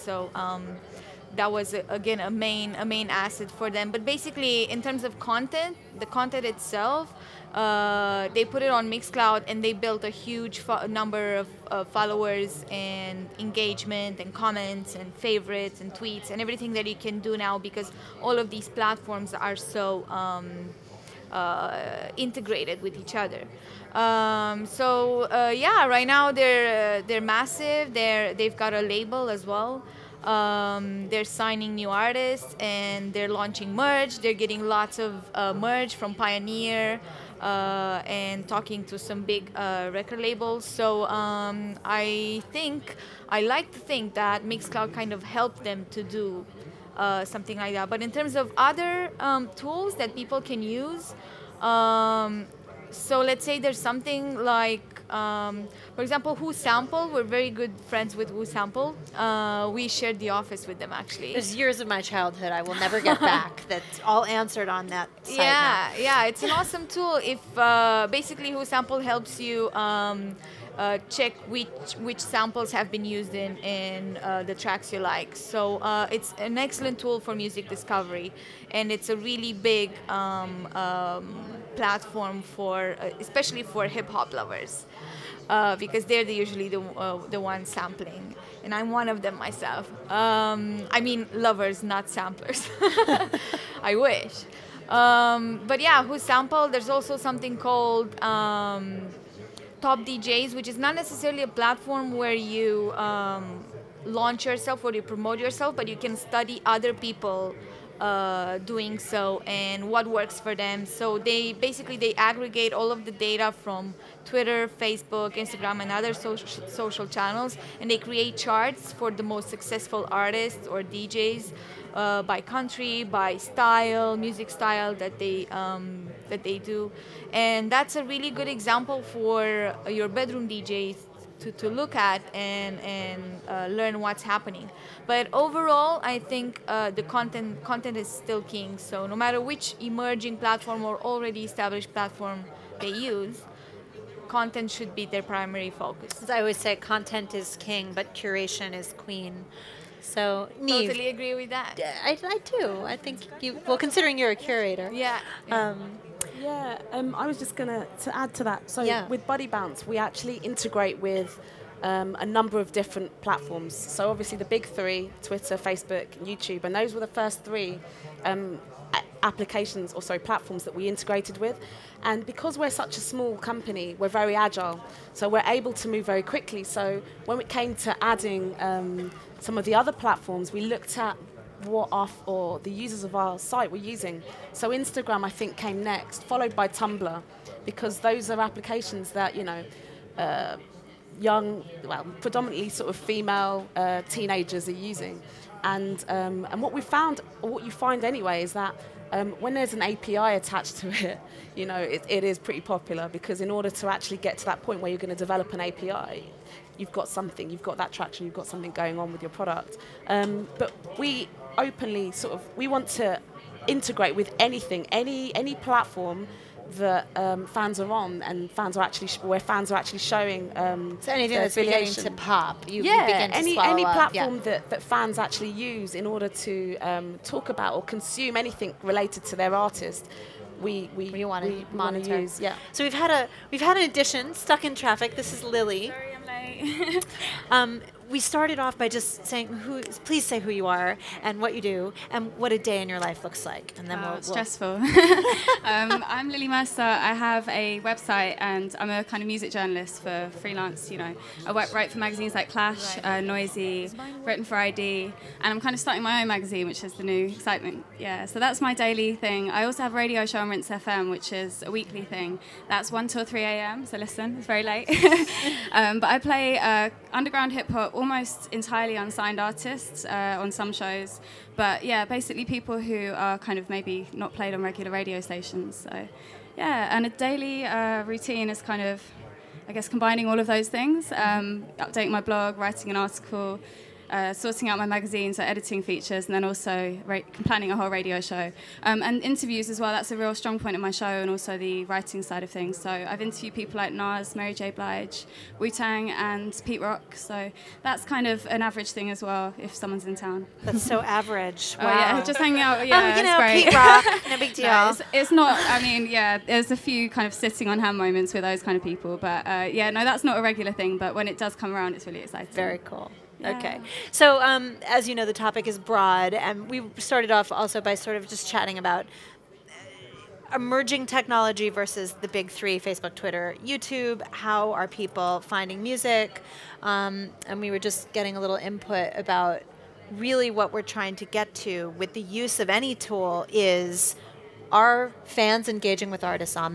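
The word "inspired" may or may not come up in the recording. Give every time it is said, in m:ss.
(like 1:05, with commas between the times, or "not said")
not said.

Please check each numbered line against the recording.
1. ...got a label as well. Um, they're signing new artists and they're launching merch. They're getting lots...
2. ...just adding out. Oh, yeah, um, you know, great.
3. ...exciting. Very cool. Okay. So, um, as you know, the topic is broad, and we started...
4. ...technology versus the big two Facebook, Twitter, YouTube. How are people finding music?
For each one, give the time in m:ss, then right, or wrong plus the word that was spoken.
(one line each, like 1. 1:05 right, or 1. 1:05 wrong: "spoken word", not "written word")
1. 0:28 right
2. 5:02 wrong: "hanging", not "adding"
3. 5:12 right
4. 5:21 wrong: "three", not "two".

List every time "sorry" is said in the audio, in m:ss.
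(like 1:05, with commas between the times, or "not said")
2:50, 3:55.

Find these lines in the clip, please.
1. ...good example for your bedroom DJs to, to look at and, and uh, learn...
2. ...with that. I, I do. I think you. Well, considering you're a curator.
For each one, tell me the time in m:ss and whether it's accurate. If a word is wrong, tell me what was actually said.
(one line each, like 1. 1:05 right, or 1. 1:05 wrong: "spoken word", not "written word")
1. 2:08 right
2. 2:31 right.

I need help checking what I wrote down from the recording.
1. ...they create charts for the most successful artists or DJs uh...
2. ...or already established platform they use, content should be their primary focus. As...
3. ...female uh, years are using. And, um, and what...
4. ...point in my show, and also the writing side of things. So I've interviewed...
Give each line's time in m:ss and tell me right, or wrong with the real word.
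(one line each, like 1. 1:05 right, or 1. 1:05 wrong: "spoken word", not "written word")
1. 1:57 right
2. 2:20 right
3. 3:12 wrong: "teenagers", not "years"
4. 4:50 right.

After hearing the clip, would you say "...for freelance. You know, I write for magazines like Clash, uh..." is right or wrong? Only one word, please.
right.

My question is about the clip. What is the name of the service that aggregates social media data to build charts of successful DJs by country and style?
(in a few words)
Top DJs.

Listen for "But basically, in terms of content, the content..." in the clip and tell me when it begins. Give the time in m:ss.
0:03.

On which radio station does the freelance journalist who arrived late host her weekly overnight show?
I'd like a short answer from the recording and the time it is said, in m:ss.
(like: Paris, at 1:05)
Rinse FM, at 4:20.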